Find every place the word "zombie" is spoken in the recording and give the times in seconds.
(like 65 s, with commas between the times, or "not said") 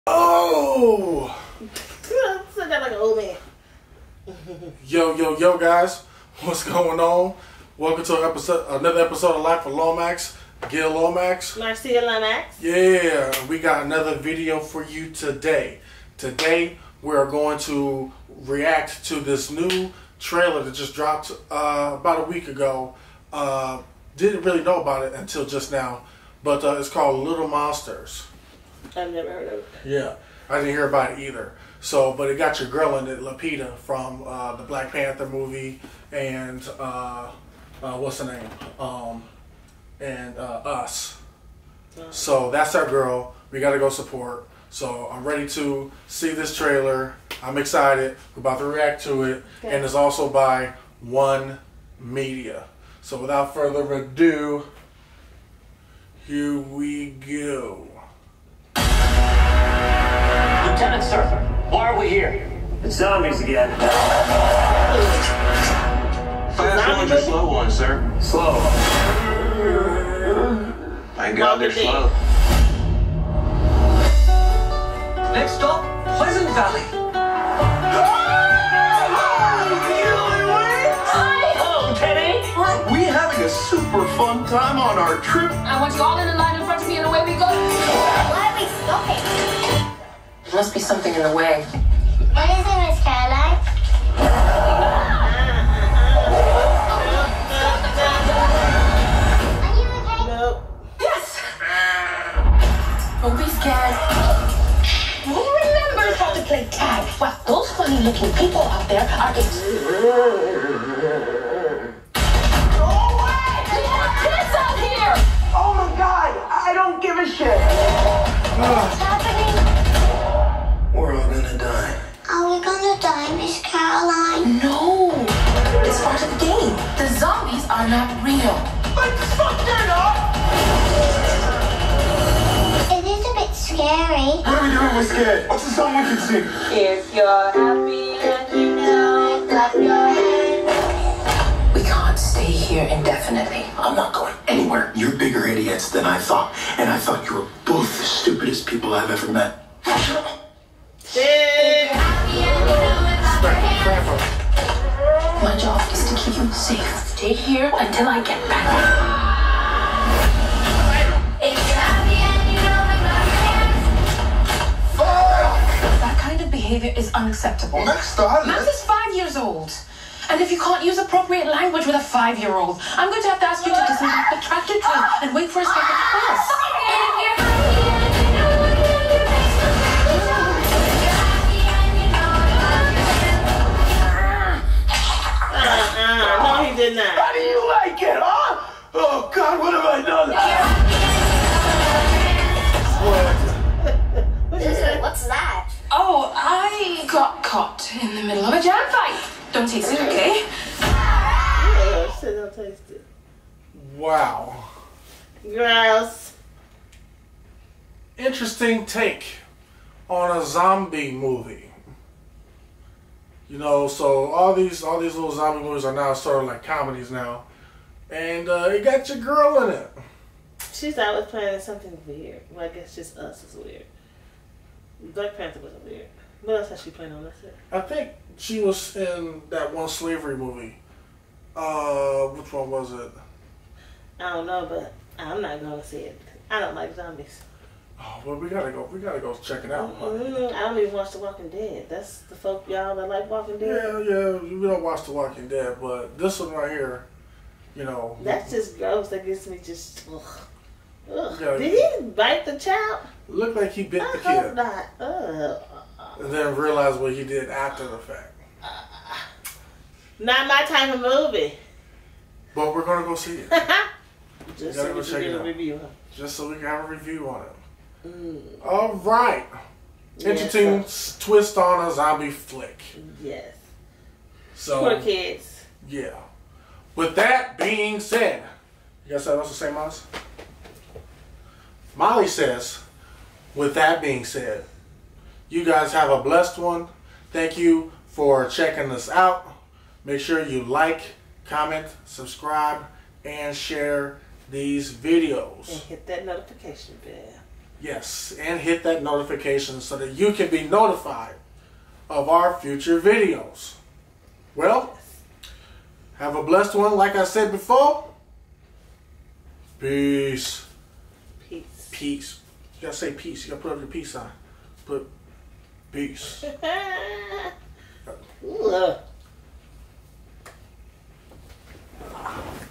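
62 s, 210 s, 215 s, 236 s, 271 s.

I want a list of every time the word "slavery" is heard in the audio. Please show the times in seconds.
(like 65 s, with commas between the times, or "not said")
229 s.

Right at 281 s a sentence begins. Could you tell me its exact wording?
Molly says, with that being said, you guys have a blessed one.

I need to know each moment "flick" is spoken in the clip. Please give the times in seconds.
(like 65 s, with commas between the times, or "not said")
272 s.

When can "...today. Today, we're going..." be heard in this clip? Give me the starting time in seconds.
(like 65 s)
15 s.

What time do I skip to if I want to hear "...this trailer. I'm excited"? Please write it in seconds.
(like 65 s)
46 s.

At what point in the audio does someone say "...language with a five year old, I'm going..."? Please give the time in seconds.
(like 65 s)
171 s.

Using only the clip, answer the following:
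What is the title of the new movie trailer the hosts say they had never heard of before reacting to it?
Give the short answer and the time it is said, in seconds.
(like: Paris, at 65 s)
Little Monsters, at 27 s.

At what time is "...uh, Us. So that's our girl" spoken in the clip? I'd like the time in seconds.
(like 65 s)
40 s.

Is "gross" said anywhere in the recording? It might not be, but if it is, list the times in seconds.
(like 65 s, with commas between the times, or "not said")
205 s, 248 s.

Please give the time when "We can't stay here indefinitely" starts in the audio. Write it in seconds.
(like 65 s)
141 s.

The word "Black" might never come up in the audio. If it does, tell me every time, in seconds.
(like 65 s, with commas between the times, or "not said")
34 s, 225 s.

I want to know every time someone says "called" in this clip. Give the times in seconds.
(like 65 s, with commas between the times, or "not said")
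26 s.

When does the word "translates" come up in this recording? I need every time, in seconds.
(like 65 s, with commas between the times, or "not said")
not said.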